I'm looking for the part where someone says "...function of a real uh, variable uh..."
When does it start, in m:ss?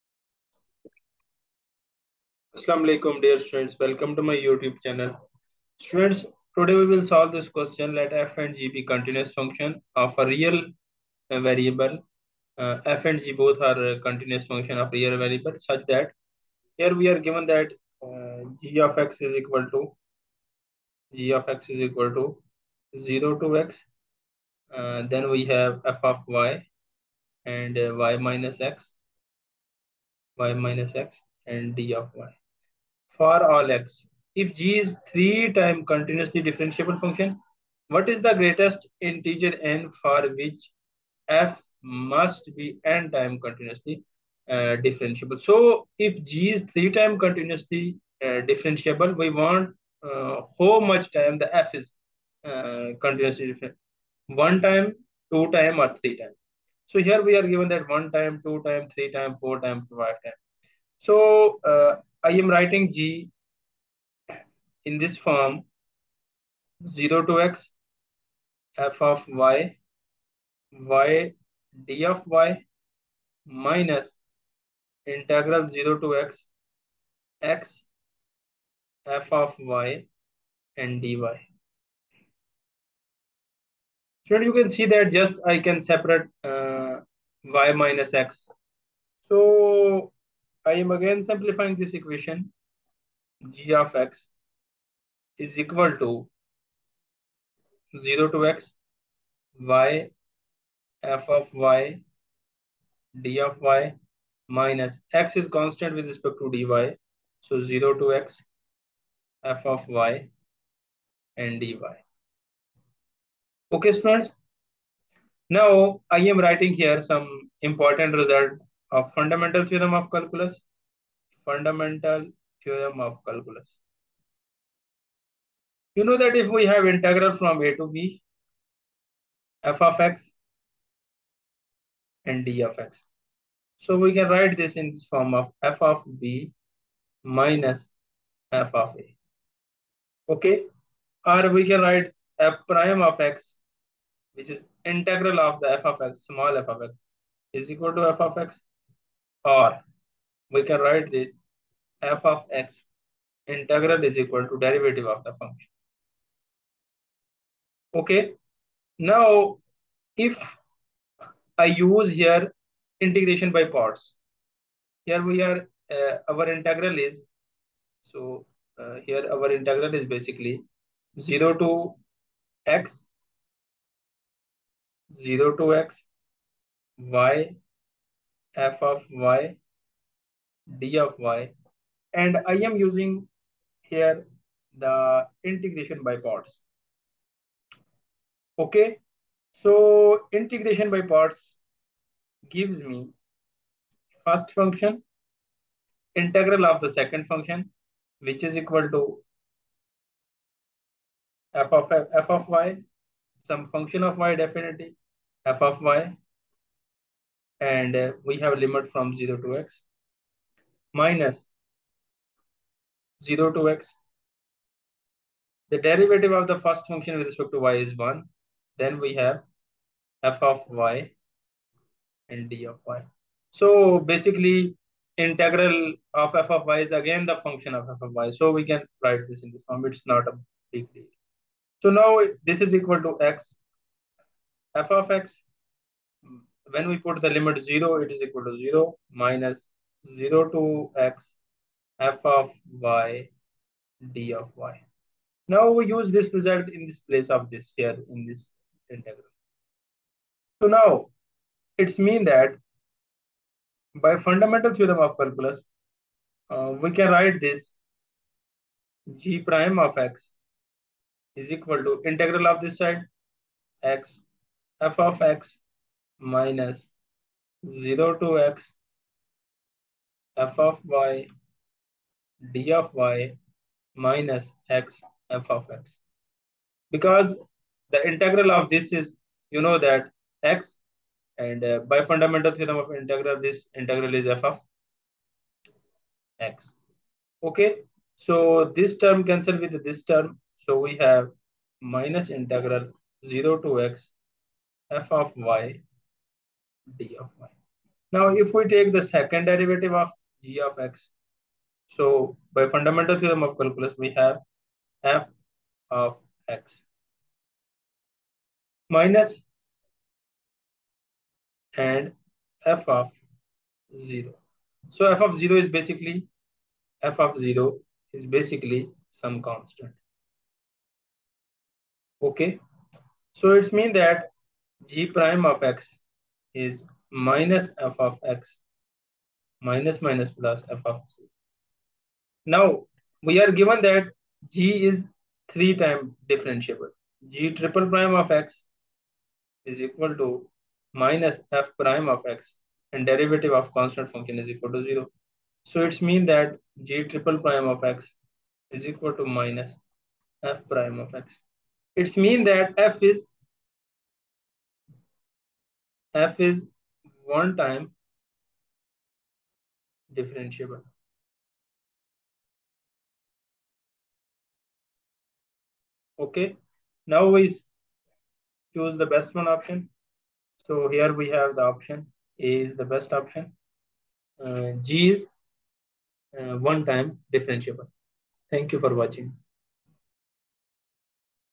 0:09.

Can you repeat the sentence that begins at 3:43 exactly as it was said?
So basically, integral of f of y is again the function of f of y.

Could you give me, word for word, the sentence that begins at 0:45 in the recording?
So if g is three time continuously uh, differentiable, we want uh, how much time the f is uh, continuously different.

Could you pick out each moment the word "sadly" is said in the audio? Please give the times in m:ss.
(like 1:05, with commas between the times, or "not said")
not said.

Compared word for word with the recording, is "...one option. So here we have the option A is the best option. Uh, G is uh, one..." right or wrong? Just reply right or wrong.
right.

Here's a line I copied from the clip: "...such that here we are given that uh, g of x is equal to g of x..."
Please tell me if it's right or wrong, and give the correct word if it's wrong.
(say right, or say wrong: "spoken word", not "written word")
right.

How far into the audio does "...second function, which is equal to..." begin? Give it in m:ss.
3:16.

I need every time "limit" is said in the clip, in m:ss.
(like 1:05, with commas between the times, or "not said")
3:28, 3:57.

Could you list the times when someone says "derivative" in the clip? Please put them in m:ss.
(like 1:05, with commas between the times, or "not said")
2:34, 3:35, 4:59, 5:43.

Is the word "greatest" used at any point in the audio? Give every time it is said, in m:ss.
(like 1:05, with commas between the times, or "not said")
0:38.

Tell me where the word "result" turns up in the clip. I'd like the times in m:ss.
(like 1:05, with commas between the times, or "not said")
1:58, 4:06.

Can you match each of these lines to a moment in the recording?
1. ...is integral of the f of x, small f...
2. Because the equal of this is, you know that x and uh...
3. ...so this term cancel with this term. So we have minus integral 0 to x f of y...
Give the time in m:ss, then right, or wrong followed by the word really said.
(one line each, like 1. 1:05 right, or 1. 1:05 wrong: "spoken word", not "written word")
1. 2:24 right
2. 4:36 wrong: "integral", not "equal"
3. 4:48 right.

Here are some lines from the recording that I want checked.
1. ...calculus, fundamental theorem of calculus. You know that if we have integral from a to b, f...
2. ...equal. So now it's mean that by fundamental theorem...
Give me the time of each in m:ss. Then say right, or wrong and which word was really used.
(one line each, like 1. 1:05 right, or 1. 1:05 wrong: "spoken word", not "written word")
1. 2:00 right
2. 4:08 wrong: "integral", not "equal".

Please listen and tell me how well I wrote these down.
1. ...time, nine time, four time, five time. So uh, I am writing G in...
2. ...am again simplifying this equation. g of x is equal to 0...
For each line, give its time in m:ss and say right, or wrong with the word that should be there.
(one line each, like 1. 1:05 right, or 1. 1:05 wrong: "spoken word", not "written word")
1. 0:58 wrong: "three", not "nine"
2. 1:30 right.